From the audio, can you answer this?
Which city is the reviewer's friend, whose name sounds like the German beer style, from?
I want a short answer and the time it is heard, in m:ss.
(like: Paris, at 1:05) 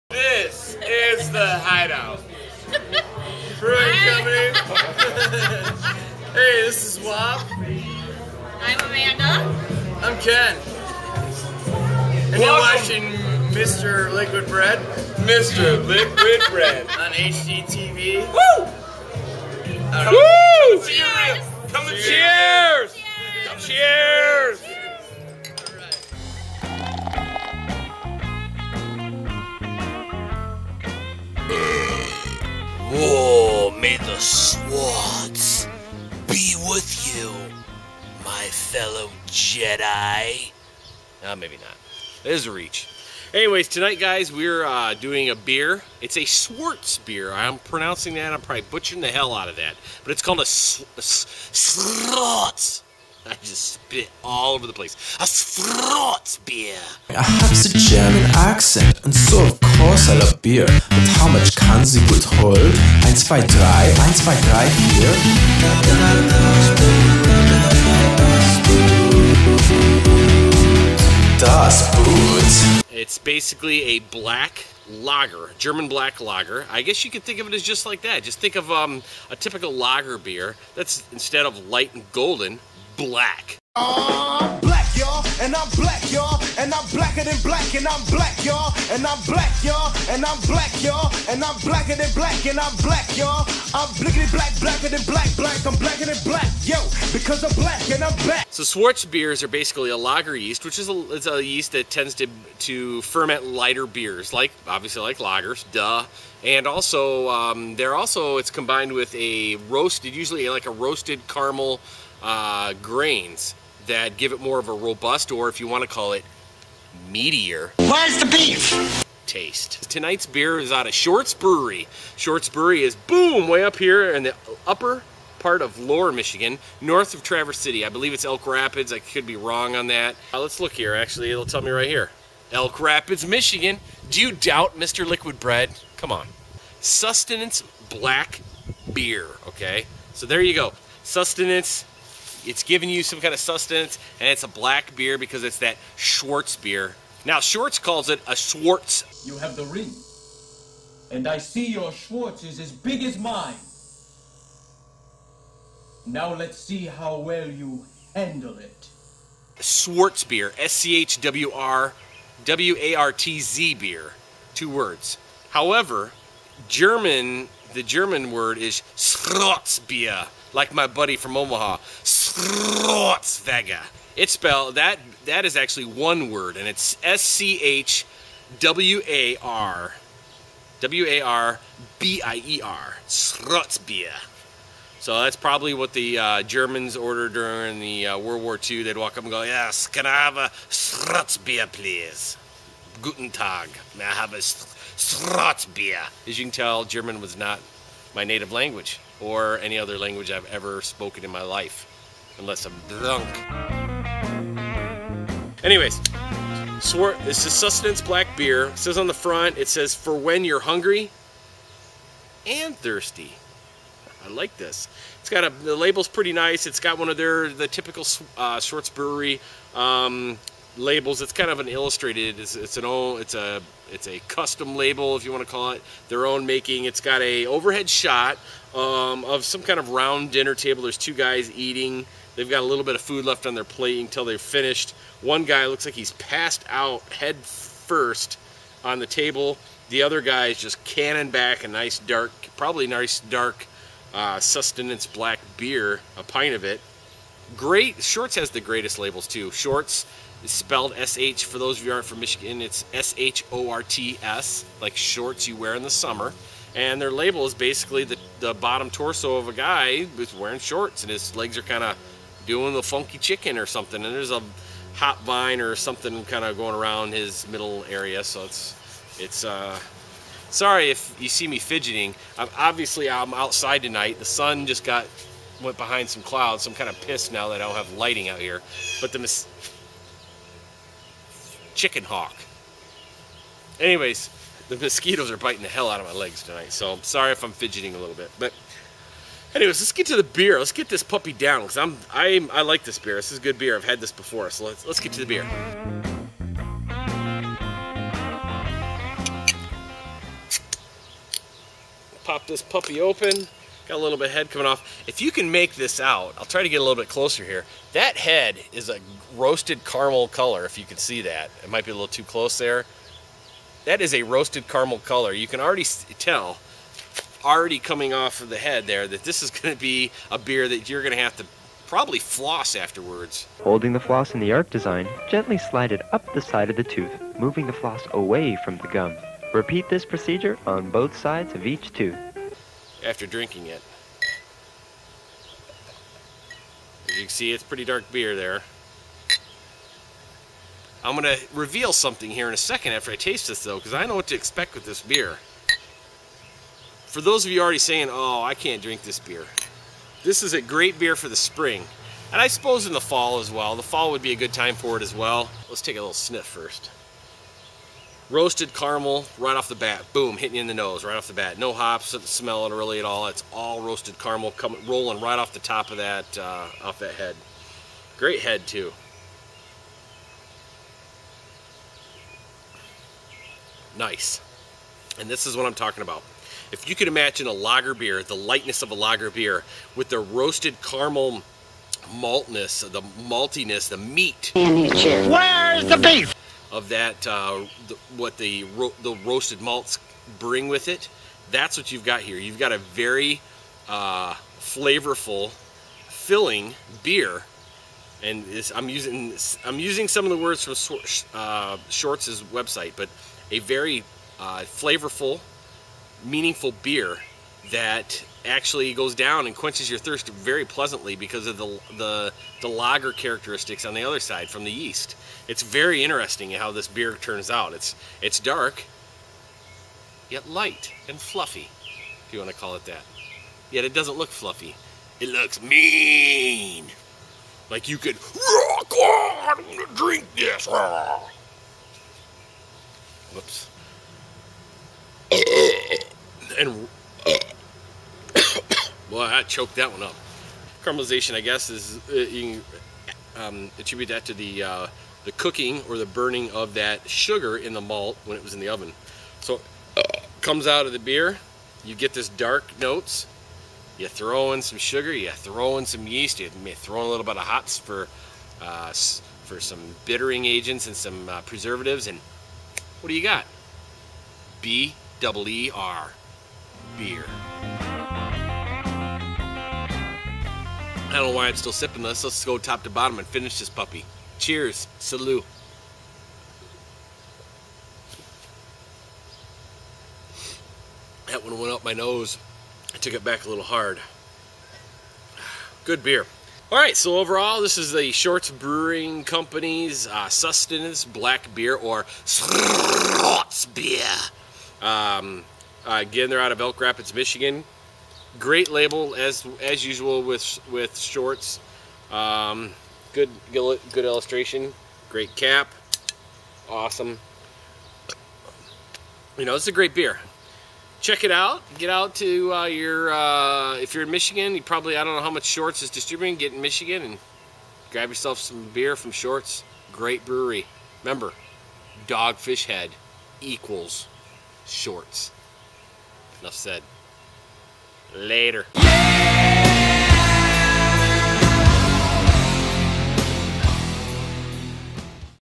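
Omaha, at 2:50.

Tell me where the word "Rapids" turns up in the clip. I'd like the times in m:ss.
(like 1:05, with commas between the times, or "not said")
2:08, 2:12, 8:16.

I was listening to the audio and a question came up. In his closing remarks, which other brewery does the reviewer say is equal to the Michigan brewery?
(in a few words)
Dogfish Head.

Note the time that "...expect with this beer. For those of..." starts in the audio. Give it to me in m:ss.
5:44.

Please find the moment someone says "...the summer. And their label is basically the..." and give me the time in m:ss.
4:15.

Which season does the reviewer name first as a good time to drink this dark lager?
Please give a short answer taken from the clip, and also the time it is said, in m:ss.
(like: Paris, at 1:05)
spring, at 5:50.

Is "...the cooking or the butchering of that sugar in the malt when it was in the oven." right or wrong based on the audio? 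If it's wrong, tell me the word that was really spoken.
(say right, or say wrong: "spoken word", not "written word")
wrong: "burning", not "butchering".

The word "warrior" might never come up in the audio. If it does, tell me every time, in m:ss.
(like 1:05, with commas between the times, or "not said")
not said.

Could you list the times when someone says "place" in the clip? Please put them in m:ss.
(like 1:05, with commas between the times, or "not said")
0:54.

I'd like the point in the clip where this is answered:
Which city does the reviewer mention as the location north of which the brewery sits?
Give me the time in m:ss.
2:06.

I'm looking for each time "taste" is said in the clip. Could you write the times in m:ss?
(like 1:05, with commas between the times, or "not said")
1:59, 5:43.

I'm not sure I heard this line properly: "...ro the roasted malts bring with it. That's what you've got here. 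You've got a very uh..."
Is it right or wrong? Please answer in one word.
right.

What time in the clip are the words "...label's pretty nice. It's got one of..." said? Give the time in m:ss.
3:35.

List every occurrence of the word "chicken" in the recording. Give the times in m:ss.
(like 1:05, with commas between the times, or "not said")
4:23, 4:41.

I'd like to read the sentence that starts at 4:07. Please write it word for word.
Great Shorts has the greatest labels too.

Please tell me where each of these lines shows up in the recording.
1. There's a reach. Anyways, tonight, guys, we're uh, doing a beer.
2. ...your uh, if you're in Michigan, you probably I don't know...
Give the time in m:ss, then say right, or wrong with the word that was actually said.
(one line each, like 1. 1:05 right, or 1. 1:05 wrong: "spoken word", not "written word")
1. 0:42 right
2. 8:32 right.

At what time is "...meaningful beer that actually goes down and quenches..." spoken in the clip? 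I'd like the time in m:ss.
6:46.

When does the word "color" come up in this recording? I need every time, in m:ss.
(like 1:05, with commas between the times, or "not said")
5:10, 5:14.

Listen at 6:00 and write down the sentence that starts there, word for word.
Boom, hitting you in the nose right off the bat.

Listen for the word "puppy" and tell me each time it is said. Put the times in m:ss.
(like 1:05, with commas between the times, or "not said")
4:51, 5:02, 7:53.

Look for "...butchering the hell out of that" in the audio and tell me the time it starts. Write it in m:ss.
0:48.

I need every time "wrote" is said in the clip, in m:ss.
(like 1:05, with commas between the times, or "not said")
not said.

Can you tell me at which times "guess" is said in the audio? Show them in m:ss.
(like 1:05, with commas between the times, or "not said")
1:16, 7:21.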